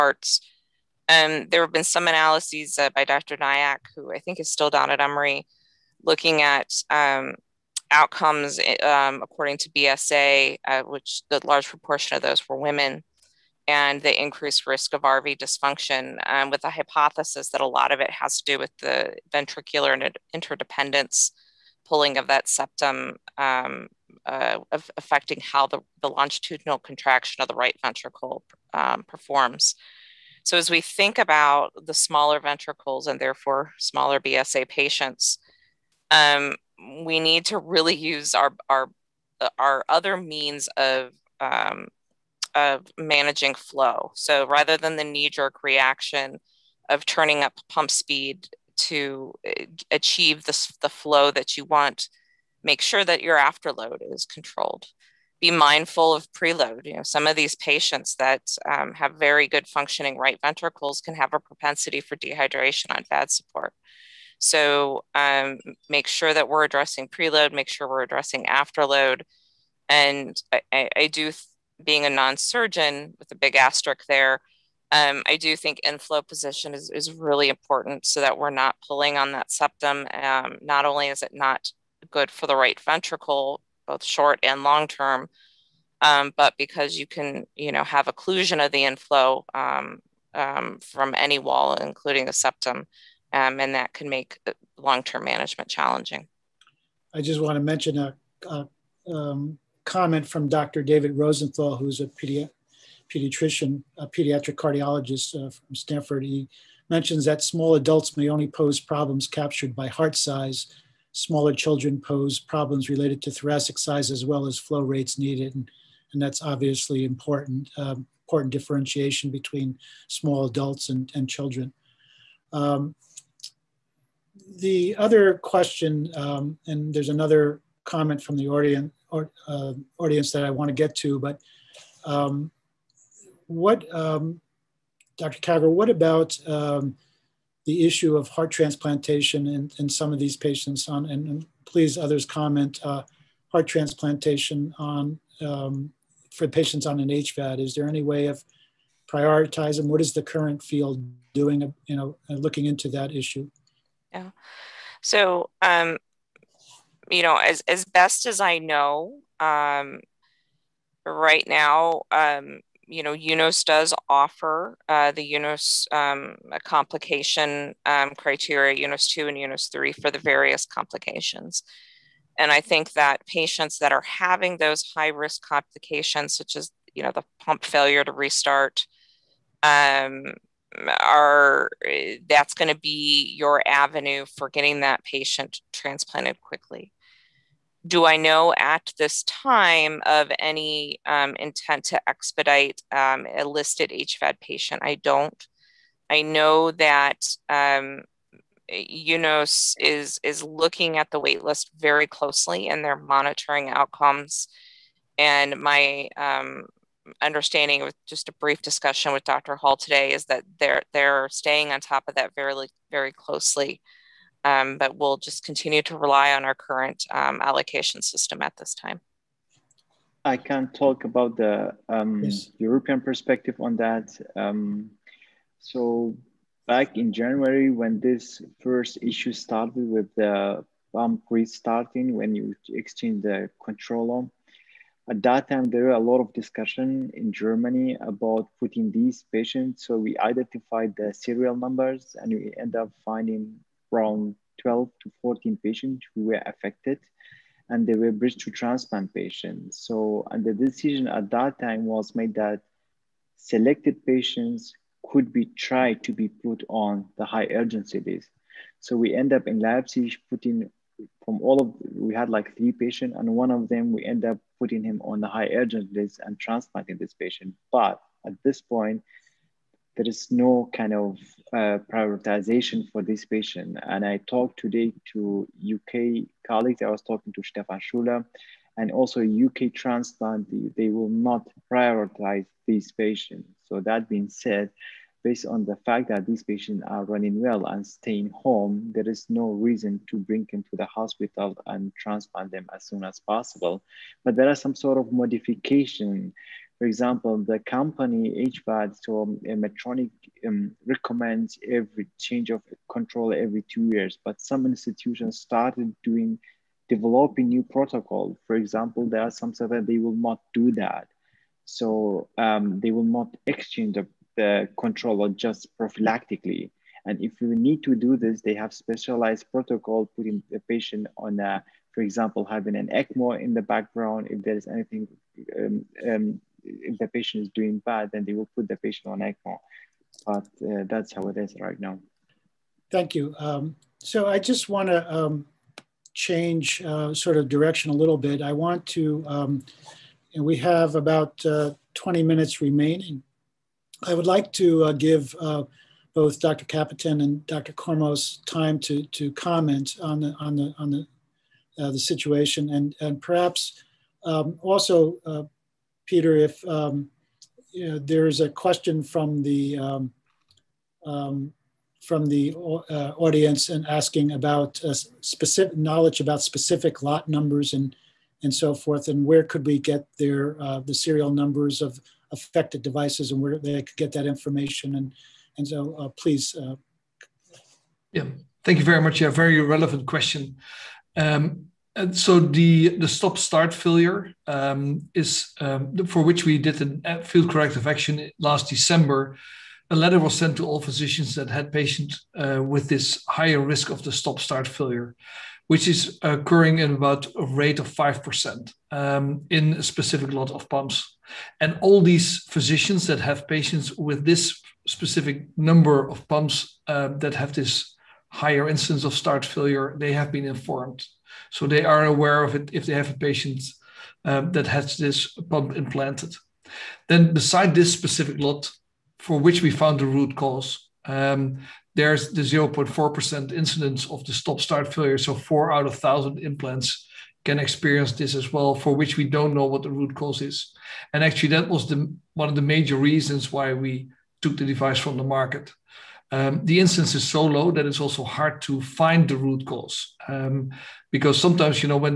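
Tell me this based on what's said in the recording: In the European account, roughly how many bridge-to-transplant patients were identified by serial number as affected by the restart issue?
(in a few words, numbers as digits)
12 to 14.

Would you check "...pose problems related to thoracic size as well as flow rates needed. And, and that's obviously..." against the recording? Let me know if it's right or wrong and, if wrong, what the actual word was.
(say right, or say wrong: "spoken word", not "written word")
right.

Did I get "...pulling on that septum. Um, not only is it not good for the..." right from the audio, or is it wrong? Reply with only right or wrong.
right.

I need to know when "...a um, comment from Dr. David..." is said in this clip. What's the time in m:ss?
1:38.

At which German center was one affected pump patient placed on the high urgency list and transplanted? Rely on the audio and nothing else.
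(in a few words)
Leipzig.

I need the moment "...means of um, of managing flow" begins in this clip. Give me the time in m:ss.
0:40.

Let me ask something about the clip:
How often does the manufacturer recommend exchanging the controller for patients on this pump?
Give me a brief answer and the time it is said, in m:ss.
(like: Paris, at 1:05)
every 2 years, at 5:03.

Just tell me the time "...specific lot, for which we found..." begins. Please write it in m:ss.
6:57.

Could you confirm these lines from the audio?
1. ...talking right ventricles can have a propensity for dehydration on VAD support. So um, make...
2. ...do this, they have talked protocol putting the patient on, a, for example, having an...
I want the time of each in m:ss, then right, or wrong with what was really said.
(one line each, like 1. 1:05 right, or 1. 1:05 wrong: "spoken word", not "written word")
1. 0:59 wrong: "functioning", not "talking"
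2. 5:17 wrong: "specialized", not "talked".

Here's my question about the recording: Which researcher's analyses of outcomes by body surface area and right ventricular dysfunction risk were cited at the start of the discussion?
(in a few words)
Dr. Nayak.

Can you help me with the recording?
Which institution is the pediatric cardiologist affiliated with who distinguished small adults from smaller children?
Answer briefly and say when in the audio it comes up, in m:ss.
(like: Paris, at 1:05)
Stanford, at 1:45.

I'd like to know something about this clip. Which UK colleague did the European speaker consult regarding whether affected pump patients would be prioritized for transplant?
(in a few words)
Stephan Schueler.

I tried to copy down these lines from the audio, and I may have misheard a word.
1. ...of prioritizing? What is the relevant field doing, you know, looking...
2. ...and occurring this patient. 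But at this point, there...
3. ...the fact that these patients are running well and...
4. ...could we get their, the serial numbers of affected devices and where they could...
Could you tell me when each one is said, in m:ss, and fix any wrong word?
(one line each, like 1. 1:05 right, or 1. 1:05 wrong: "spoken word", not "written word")
1. 2:28 wrong: "current", not "relevant"
2. 4:26 wrong: "transplanting", not "occurring"
3. 4:45 right
4. 6:09 right.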